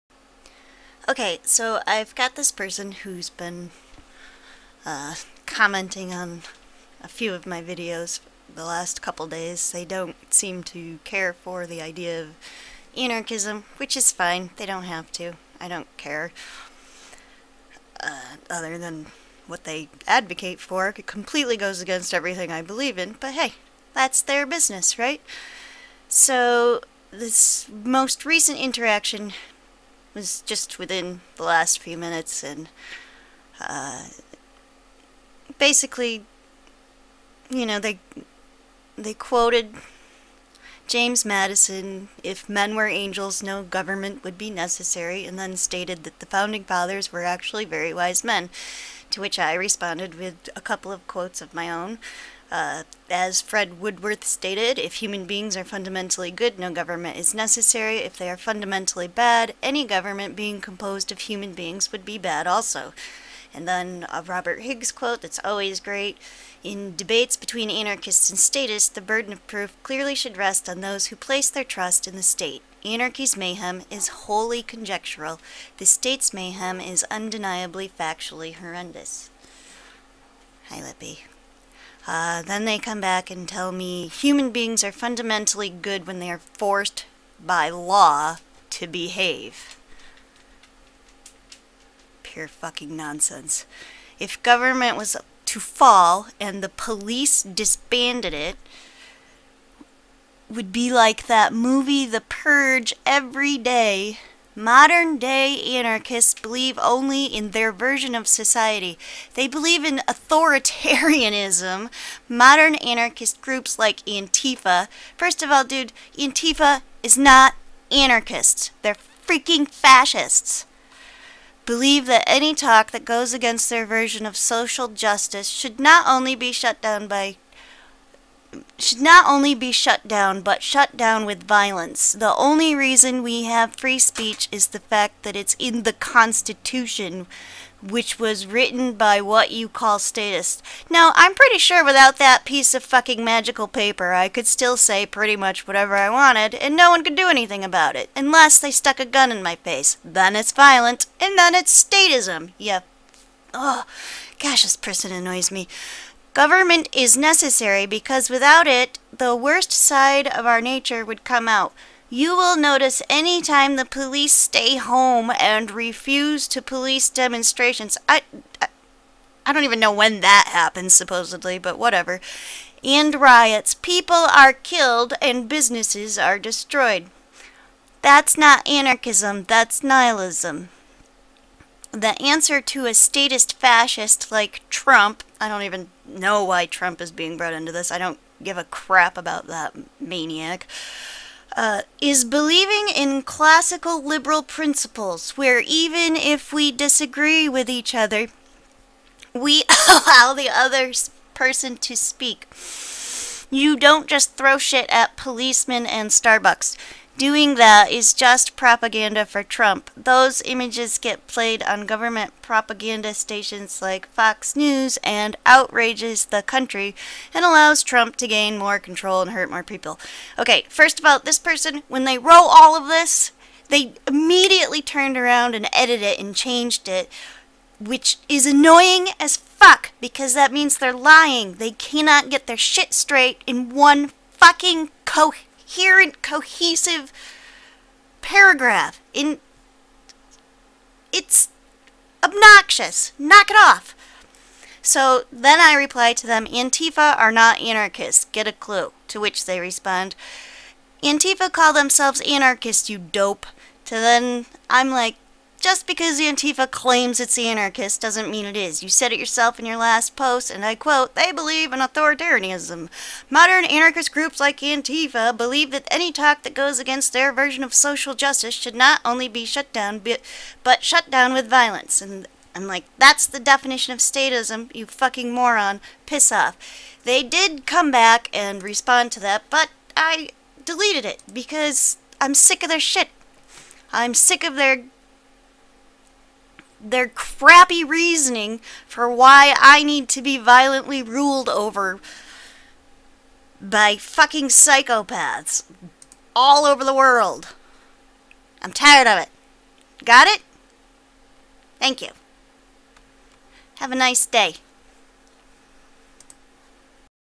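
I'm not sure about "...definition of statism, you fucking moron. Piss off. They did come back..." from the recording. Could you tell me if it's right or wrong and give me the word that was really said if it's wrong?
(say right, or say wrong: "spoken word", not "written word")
right.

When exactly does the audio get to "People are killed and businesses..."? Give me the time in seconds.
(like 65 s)
173 s.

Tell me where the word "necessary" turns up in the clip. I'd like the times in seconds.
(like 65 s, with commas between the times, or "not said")
44 s, 57 s, 157 s.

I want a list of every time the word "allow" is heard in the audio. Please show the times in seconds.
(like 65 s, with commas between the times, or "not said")
199 s, 217 s.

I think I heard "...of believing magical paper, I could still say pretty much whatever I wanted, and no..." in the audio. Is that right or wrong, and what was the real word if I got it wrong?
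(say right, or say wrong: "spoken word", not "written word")
wrong: "fucking", not "believing".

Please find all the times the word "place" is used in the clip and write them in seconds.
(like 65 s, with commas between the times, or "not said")
71 s.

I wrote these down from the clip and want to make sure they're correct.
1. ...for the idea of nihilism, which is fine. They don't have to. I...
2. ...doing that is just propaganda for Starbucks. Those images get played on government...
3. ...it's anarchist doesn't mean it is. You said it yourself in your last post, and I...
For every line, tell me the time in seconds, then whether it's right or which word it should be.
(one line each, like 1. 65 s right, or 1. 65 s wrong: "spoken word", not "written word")
1. 11 s wrong: "anarchism", not "nihilism"
2. 207 s wrong: "Trump", not "Starbucks"
3. 257 s right.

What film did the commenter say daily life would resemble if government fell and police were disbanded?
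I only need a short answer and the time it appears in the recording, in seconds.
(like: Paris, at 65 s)
The Purge, at 102 s.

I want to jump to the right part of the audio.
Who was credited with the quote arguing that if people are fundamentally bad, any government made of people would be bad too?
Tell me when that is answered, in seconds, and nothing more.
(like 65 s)
53 s.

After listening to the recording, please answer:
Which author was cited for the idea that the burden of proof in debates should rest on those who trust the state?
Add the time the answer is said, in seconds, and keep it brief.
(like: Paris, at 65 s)
Robert Higgs, at 64 s.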